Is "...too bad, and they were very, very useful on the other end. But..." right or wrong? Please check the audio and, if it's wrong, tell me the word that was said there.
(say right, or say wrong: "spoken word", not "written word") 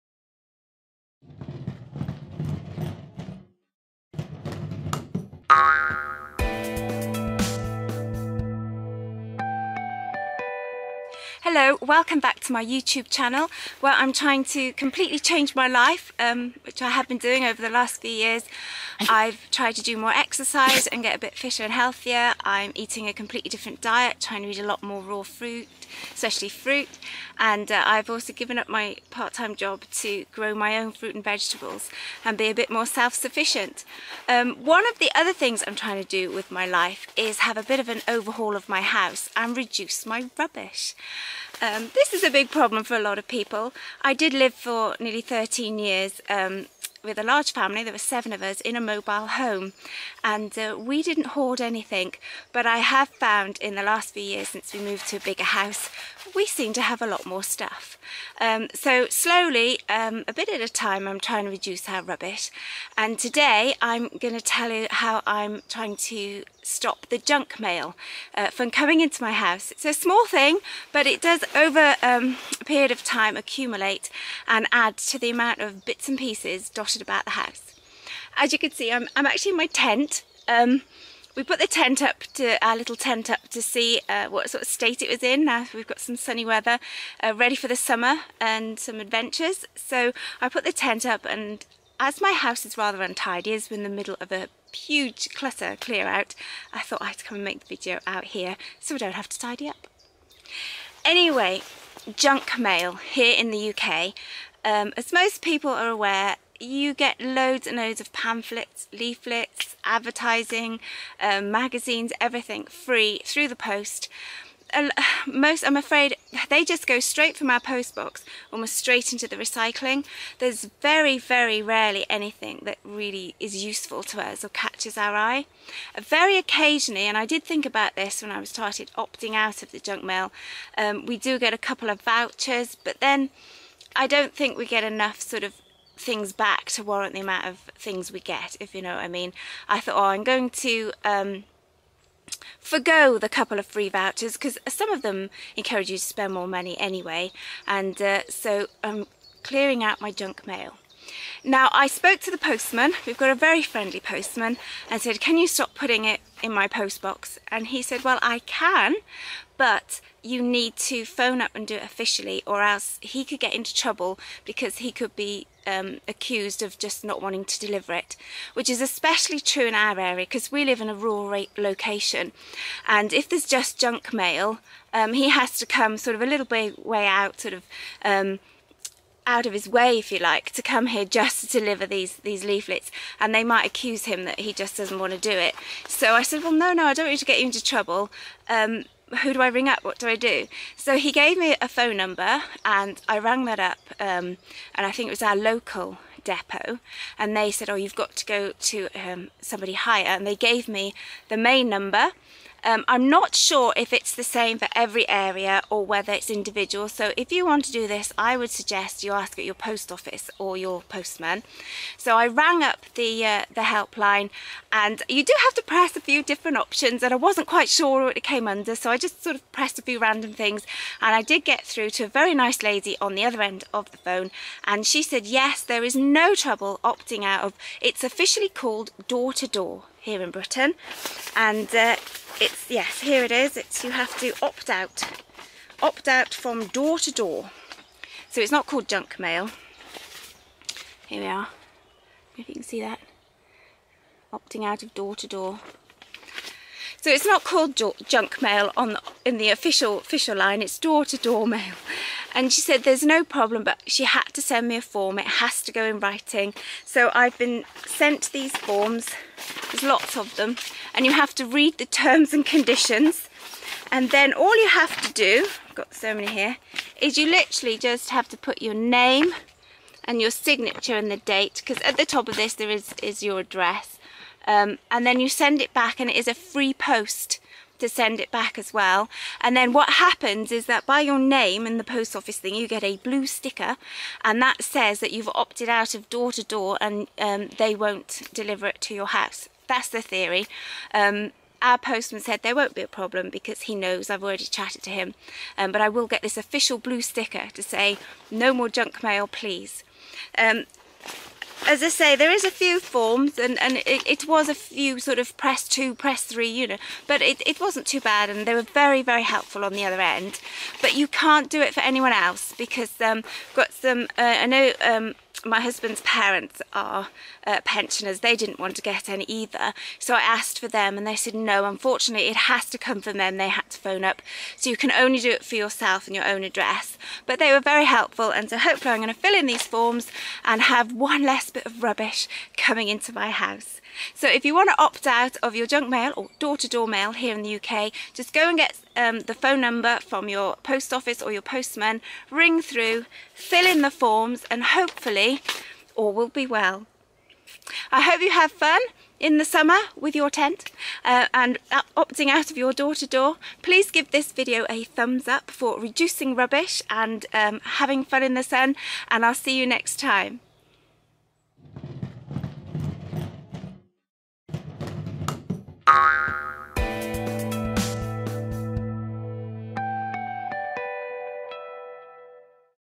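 wrong: "helpful", not "useful".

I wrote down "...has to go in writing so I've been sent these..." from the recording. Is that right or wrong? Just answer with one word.
right.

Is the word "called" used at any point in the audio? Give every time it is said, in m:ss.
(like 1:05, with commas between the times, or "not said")
3:48, 3:58, 4:07.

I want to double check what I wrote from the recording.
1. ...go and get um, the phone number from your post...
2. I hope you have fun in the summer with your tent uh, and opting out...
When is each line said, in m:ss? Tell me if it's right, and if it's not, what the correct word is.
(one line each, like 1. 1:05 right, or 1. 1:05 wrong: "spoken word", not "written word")
1. 5:38 right
2. 5:47 right.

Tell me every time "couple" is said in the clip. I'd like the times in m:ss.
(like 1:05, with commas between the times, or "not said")
2:11, 2:23.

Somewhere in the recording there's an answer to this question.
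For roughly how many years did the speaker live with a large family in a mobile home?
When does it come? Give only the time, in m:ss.
0:45.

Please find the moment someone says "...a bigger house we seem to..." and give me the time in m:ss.
0:55.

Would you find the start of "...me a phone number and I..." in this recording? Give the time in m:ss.
3:11.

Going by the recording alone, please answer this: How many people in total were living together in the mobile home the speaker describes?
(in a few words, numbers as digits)
7.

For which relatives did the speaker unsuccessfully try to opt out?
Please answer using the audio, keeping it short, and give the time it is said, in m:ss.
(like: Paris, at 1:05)
Husband's parents, at 5:15.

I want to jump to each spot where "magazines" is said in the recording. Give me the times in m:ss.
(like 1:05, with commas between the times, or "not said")
1:51.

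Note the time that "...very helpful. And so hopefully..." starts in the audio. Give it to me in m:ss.
5:27.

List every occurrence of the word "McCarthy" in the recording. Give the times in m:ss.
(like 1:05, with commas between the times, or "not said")
not said.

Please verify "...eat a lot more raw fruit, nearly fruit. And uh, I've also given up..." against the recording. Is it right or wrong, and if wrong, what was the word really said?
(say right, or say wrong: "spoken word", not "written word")
wrong: "especially", not "nearly".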